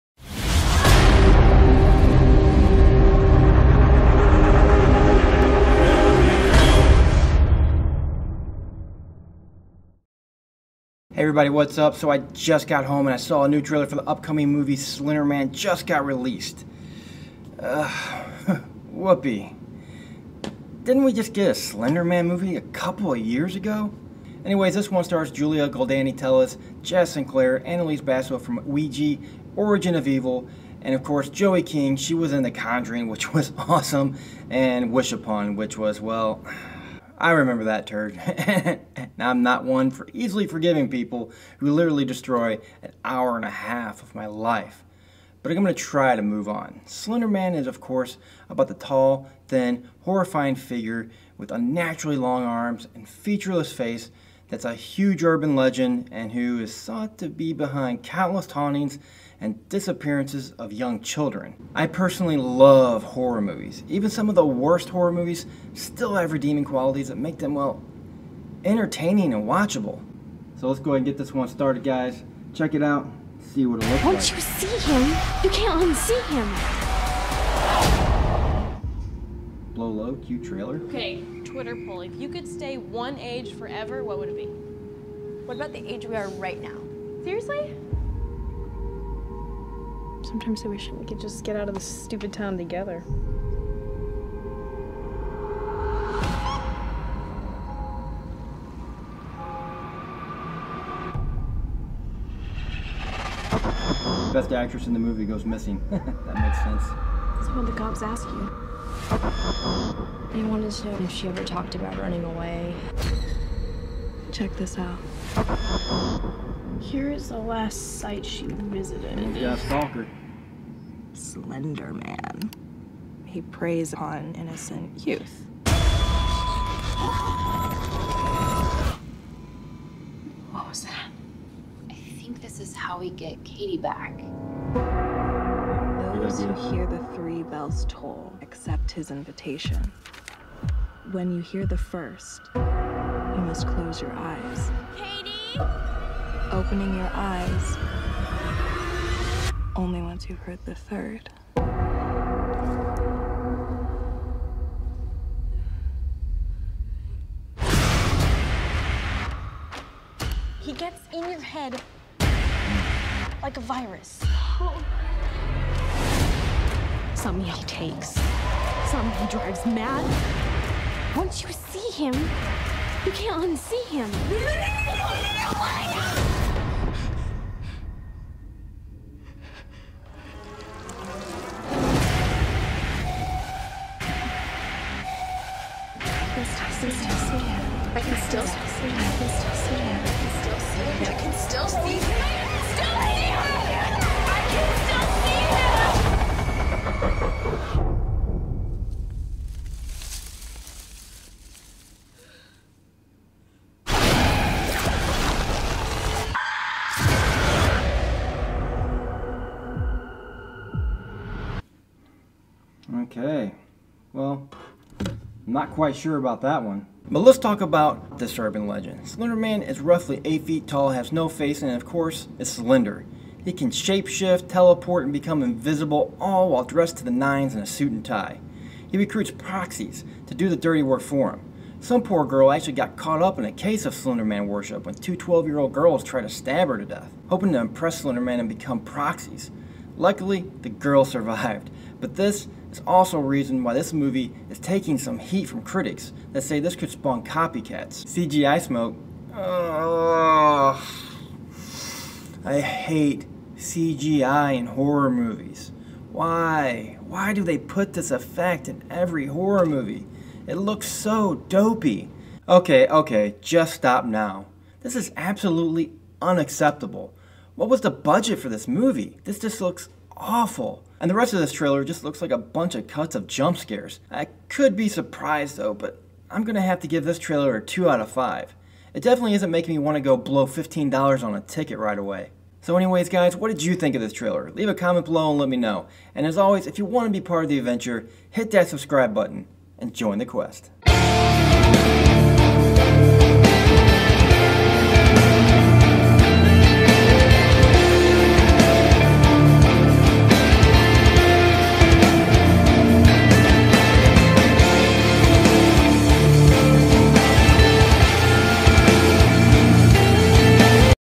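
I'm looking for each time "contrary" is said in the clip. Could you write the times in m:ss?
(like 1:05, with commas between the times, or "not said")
not said.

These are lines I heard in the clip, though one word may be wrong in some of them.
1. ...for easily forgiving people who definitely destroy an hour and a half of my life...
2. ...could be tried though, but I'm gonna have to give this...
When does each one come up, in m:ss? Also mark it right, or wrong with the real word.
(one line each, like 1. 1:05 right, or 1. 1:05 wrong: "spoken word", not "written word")
1. 0:39 wrong: "literally", not "definitely"
2. 4:34 wrong: "surprised", not "tried".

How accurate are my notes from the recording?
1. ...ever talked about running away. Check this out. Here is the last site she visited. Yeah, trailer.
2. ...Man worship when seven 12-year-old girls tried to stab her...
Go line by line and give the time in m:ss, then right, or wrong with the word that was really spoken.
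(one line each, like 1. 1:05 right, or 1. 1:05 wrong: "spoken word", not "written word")
1. 1:51 wrong: "stalker", not "trailer"
2. 3:54 wrong: "two", not "seven".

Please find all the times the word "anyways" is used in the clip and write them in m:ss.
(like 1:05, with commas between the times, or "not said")
0:24, 4:42.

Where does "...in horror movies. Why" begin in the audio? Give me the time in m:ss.
4:14.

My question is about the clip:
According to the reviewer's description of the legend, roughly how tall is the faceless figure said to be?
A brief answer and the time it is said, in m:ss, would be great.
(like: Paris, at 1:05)
8 feet, at 3:40.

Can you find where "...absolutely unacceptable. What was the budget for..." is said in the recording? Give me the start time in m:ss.
4:25.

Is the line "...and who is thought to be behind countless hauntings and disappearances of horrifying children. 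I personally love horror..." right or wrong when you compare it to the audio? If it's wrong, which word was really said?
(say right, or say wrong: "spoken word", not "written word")
wrong: "young", not "horrifying".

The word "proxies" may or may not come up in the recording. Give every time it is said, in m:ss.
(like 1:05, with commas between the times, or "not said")
3:49, 3:58.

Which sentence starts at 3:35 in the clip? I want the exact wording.
I'm not quite sure about that one.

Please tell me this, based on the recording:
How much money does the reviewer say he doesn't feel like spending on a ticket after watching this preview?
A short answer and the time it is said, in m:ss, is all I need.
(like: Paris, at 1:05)
$15, at 4:40.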